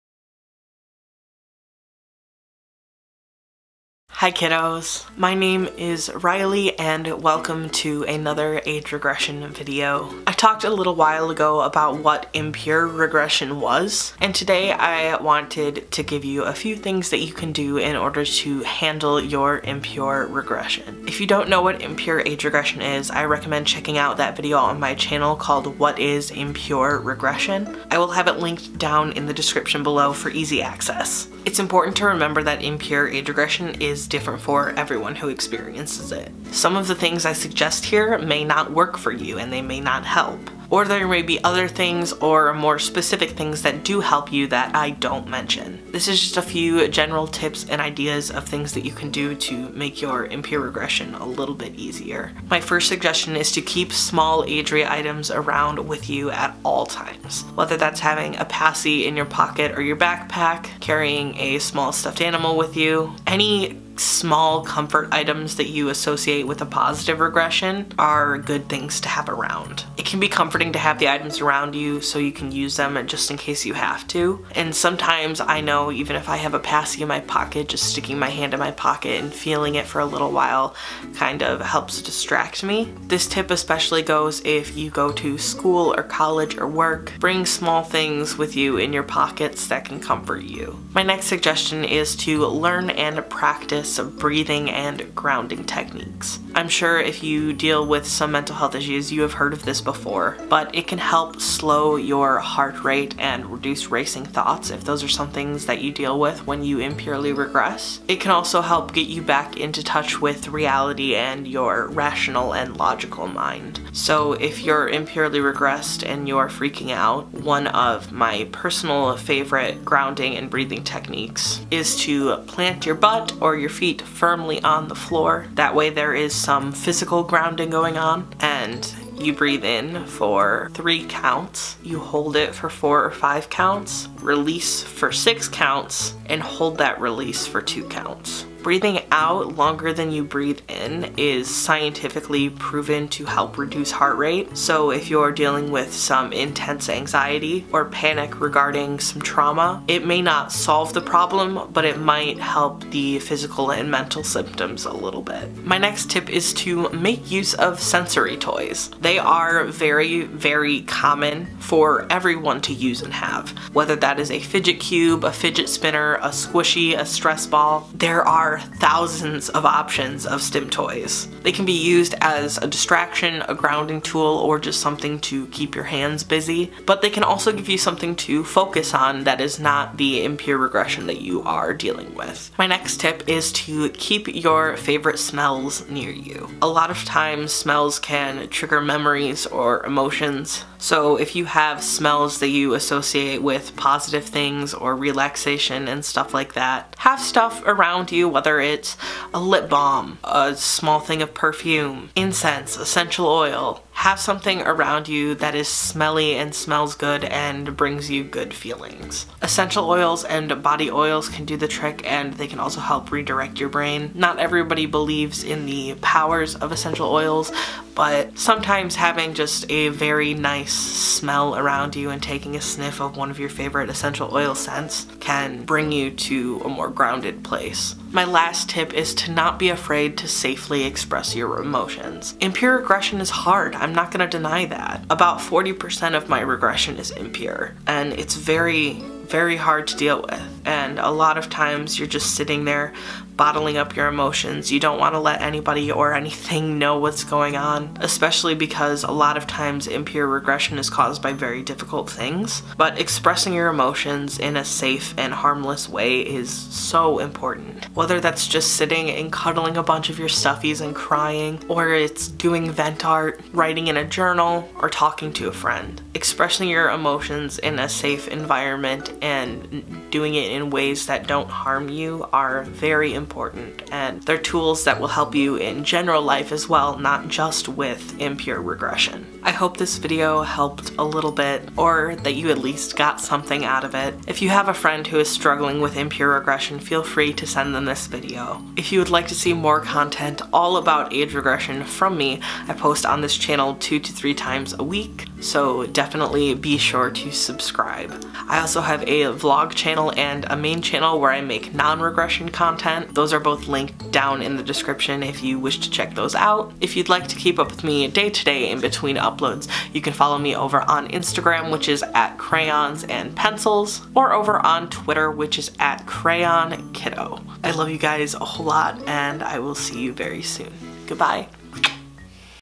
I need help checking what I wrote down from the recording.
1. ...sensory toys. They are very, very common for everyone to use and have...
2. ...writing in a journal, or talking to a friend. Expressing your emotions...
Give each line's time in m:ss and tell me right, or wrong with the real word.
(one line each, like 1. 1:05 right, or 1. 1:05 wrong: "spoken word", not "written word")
1. 2:37 right
2. 4:23 right.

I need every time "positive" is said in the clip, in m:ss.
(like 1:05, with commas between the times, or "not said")
1:06, 3:13.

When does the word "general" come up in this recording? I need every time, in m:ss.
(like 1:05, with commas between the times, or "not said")
0:46, 4:35.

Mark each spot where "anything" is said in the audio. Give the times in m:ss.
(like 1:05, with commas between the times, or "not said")
4:06.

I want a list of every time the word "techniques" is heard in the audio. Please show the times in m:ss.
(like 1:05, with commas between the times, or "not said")
1:35, 2:00.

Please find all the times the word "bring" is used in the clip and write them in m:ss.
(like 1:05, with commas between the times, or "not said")
1:27, 3:27, 3:45.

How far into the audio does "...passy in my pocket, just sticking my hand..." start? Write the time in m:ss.
1:16.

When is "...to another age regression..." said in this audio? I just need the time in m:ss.
0:07.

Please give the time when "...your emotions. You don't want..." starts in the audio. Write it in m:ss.
4:03.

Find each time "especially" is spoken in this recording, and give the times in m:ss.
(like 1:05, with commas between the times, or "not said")
1:23, 4:08.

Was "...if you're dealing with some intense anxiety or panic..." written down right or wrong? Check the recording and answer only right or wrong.
right.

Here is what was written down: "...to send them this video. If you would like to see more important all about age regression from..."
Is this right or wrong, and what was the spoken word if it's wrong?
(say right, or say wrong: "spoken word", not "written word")
wrong: "content", not "important".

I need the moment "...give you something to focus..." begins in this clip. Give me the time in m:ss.
2:57.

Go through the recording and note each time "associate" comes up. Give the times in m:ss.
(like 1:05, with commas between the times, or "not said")
1:05, 3:12.